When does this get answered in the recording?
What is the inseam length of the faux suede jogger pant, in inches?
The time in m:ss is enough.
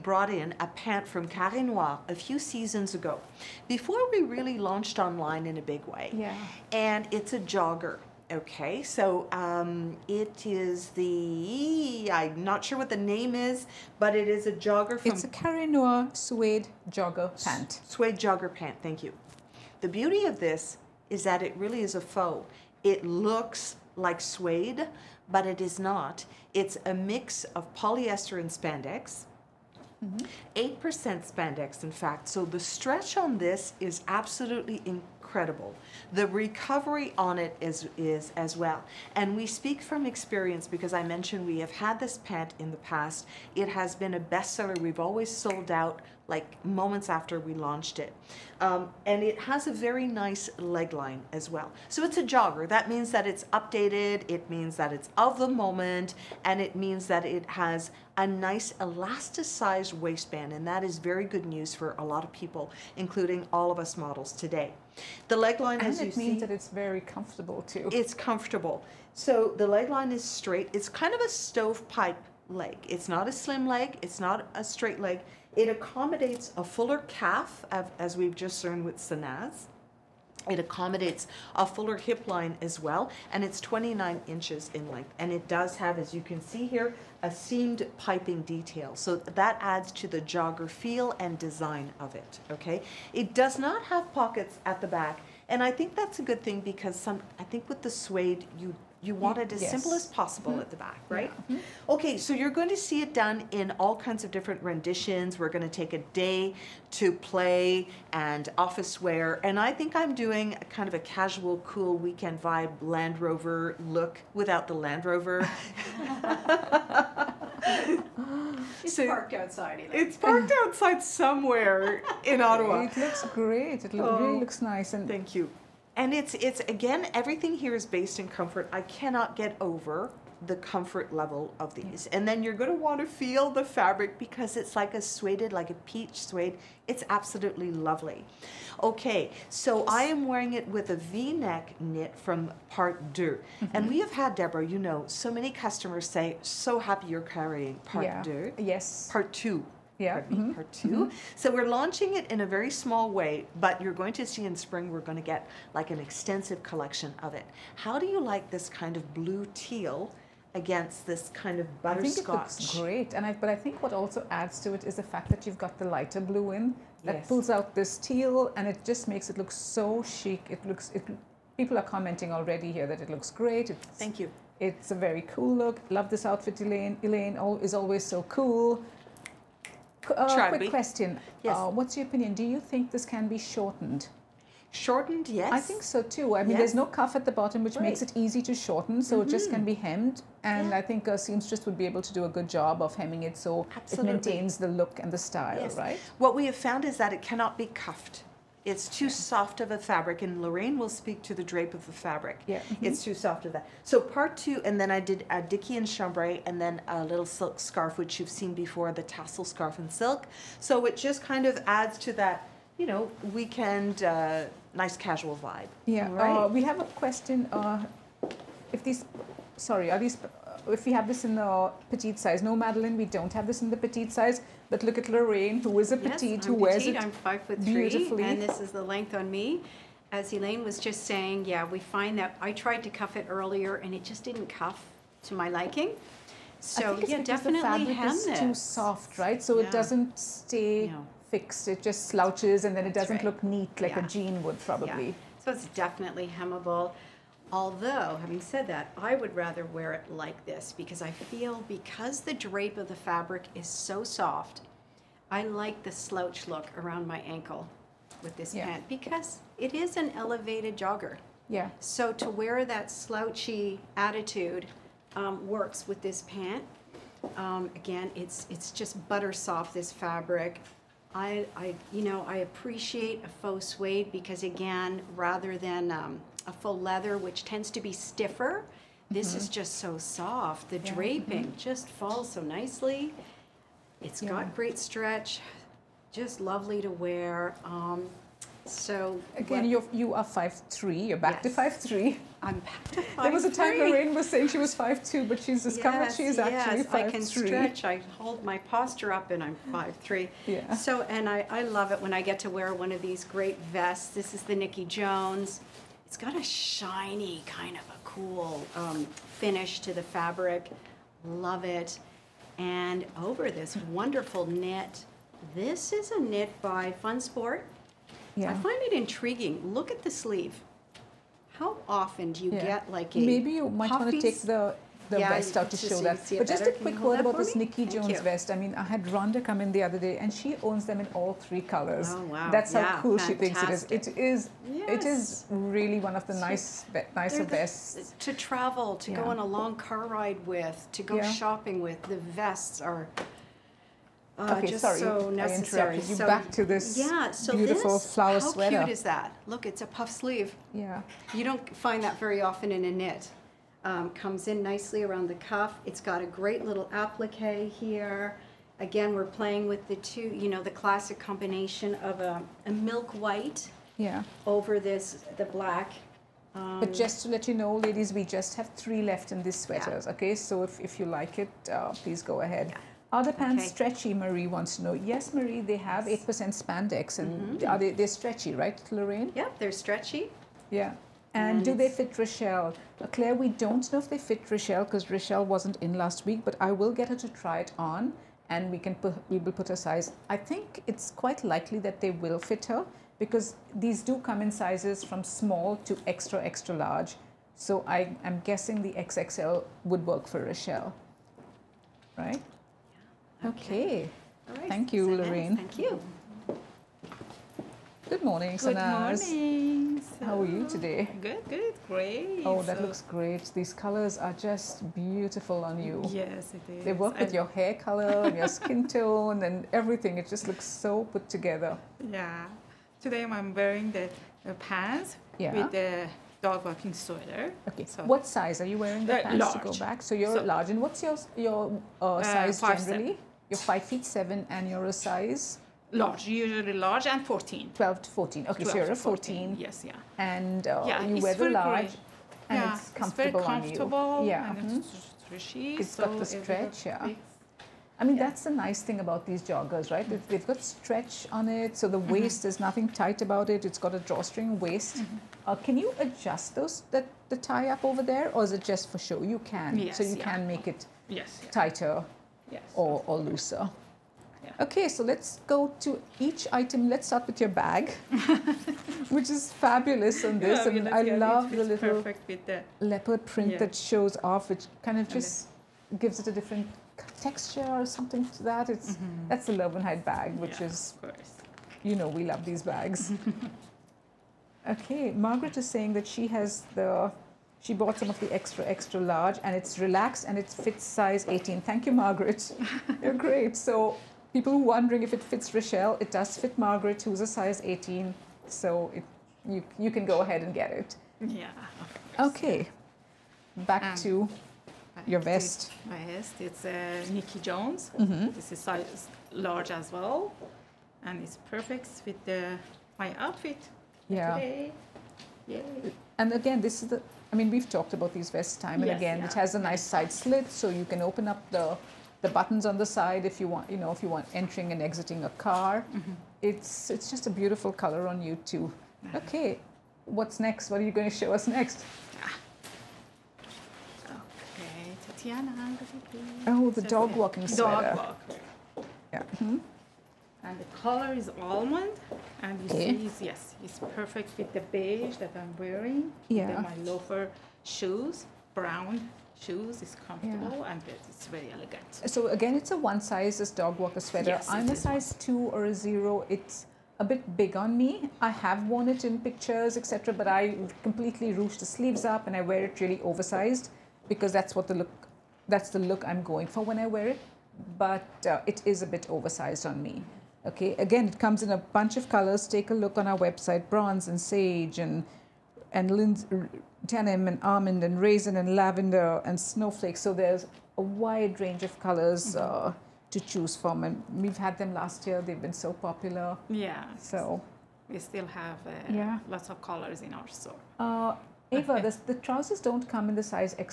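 1:23.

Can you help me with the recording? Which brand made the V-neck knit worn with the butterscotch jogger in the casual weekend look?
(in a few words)
Part 2.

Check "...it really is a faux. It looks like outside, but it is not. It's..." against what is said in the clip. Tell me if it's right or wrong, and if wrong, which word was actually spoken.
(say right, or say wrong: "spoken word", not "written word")
wrong: "suede", not "outside".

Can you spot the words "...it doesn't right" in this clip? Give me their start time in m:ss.
4:02.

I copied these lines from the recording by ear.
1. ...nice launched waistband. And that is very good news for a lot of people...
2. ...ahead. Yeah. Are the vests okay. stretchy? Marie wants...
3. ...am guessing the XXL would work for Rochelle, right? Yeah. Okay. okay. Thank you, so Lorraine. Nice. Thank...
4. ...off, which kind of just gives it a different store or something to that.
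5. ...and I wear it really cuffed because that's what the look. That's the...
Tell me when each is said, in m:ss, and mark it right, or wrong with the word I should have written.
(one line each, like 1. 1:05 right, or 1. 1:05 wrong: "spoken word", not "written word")
1. 0:58 wrong: "elasticized", not "launched"
2. 6:12 wrong: "pants", not "vests"
3. 6:38 right
4. 7:54 wrong: "texture", not "store"
5. 9:22 wrong: "oversized", not "cuffed".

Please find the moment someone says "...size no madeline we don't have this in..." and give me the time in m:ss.
3:42.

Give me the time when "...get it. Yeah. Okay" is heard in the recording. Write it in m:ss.
8:20.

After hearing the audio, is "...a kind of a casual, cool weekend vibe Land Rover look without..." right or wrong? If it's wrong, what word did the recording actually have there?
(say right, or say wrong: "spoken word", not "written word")
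right.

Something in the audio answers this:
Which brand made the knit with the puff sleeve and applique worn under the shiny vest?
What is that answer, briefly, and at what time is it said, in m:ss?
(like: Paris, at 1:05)
Fun Sport, at 5:16.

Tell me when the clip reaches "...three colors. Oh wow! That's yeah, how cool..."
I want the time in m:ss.
5:31.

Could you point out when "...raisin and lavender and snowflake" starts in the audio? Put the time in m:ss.
9:37.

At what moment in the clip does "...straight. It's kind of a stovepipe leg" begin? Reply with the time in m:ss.
1:10.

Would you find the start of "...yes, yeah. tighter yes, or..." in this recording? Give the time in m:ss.
7:41.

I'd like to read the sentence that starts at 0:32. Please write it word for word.
So the stretch on this is absolutely incredible incredible.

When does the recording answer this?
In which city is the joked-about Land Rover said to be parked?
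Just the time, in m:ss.
2:02.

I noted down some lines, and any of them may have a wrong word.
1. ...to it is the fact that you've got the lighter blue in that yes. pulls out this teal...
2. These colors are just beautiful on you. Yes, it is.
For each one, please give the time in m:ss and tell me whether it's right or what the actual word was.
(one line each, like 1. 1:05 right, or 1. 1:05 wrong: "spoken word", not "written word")
1. 2:44 right
2. 6:53 right.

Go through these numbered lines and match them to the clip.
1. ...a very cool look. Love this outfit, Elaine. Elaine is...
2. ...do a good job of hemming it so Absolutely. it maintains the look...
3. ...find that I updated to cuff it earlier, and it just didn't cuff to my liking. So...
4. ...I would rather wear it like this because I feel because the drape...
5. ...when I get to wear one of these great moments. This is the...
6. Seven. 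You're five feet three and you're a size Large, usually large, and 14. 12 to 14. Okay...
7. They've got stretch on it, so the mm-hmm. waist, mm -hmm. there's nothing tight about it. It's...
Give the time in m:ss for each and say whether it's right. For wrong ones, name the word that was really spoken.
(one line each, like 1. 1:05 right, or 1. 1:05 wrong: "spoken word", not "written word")
1. 2:54 right
2. 3:12 right
3. 3:51 wrong: "tried", not "updated"
4. 4:08 right
5. 5:02 wrong: "vests", not "moments"
6. 7:12 wrong: "seven", not "three"
7. 7:30 right.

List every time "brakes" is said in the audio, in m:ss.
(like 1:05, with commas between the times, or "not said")
not said.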